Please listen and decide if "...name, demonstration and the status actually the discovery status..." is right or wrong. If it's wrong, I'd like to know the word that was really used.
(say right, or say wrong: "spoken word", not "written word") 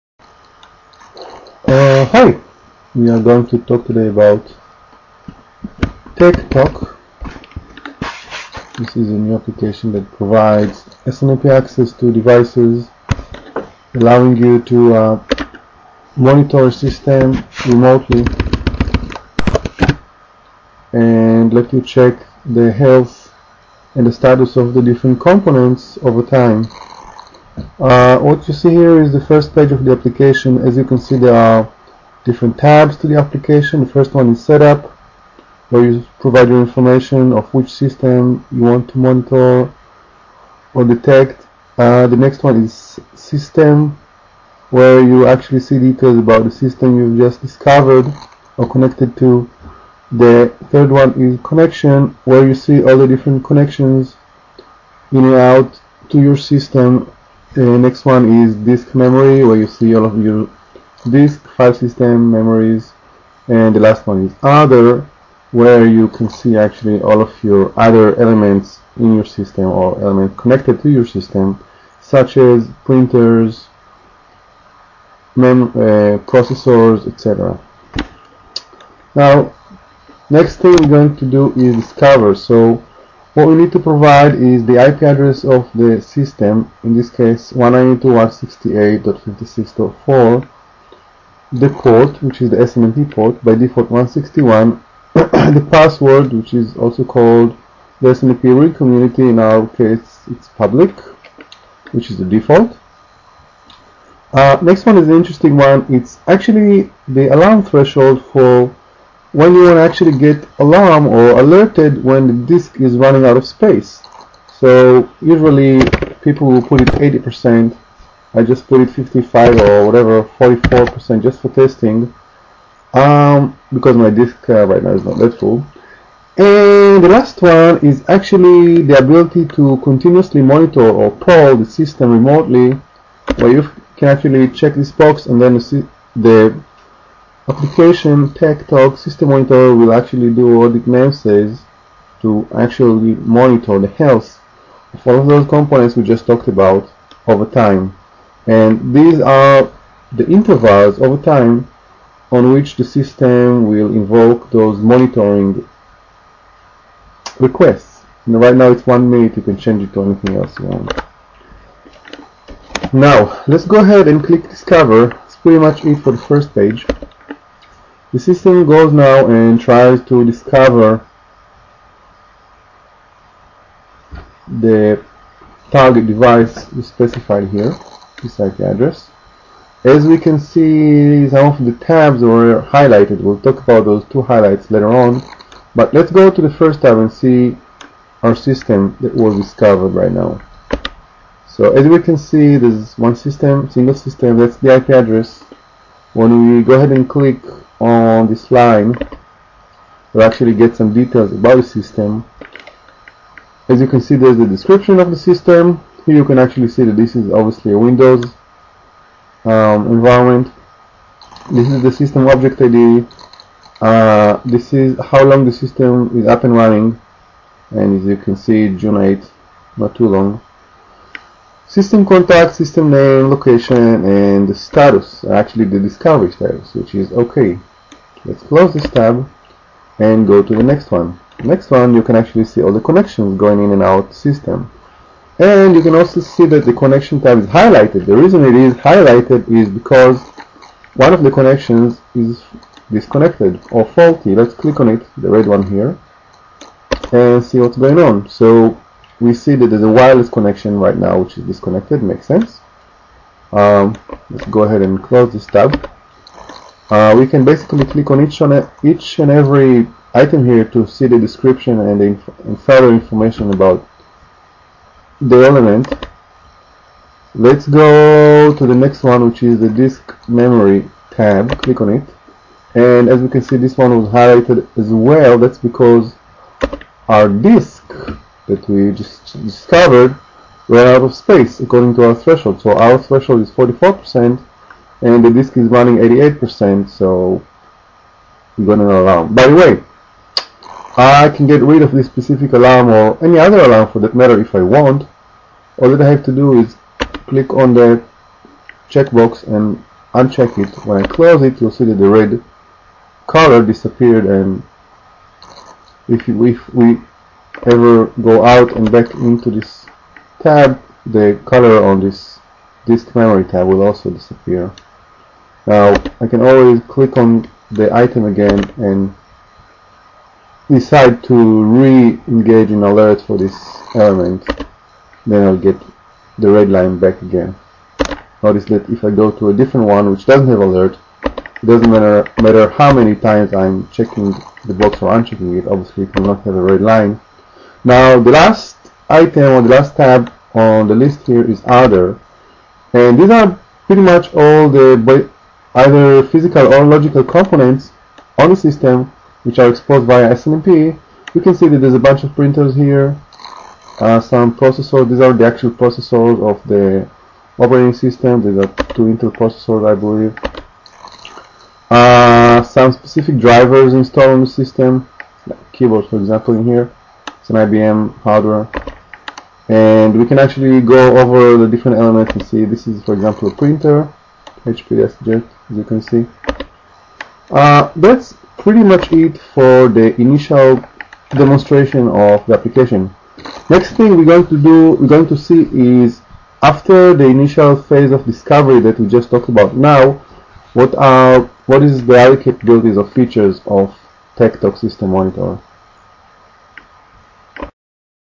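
wrong: "location", not "demonstration".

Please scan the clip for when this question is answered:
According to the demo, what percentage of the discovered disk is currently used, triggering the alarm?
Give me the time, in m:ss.
4:45.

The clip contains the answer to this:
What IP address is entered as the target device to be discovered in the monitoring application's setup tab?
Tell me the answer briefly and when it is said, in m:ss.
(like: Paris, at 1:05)
192.168.56.4, at 1:27.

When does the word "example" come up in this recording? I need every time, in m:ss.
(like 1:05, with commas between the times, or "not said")
6:06, 6:13.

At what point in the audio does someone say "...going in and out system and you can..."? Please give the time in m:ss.
3:53.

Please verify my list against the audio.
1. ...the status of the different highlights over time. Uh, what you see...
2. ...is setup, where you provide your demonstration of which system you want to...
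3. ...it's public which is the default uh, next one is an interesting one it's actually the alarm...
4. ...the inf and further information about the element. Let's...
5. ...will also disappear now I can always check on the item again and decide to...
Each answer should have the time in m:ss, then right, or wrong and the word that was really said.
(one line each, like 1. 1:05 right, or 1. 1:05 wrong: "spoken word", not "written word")
1. 0:24 wrong: "components", not "highlights"
2. 0:34 wrong: "information", not "demonstration"
3. 1:40 right
4. 4:22 right
5. 5:13 wrong: "click", not "check".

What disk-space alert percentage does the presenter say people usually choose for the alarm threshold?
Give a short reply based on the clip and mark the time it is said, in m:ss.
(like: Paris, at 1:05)
80%, at 1:56.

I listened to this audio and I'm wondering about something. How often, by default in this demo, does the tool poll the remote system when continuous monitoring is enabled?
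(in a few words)
one minute.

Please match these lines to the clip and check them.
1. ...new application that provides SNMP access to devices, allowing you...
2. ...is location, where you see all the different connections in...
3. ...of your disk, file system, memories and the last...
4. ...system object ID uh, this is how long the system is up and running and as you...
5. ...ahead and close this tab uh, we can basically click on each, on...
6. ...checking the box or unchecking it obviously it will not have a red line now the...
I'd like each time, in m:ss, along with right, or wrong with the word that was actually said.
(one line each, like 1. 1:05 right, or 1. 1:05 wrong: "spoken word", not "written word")
1. 0:09 right
2. 0:51 wrong: "connection", not "location"
3. 1:00 right
4. 3:31 right
5. 4:14 right
6. 5:33 right.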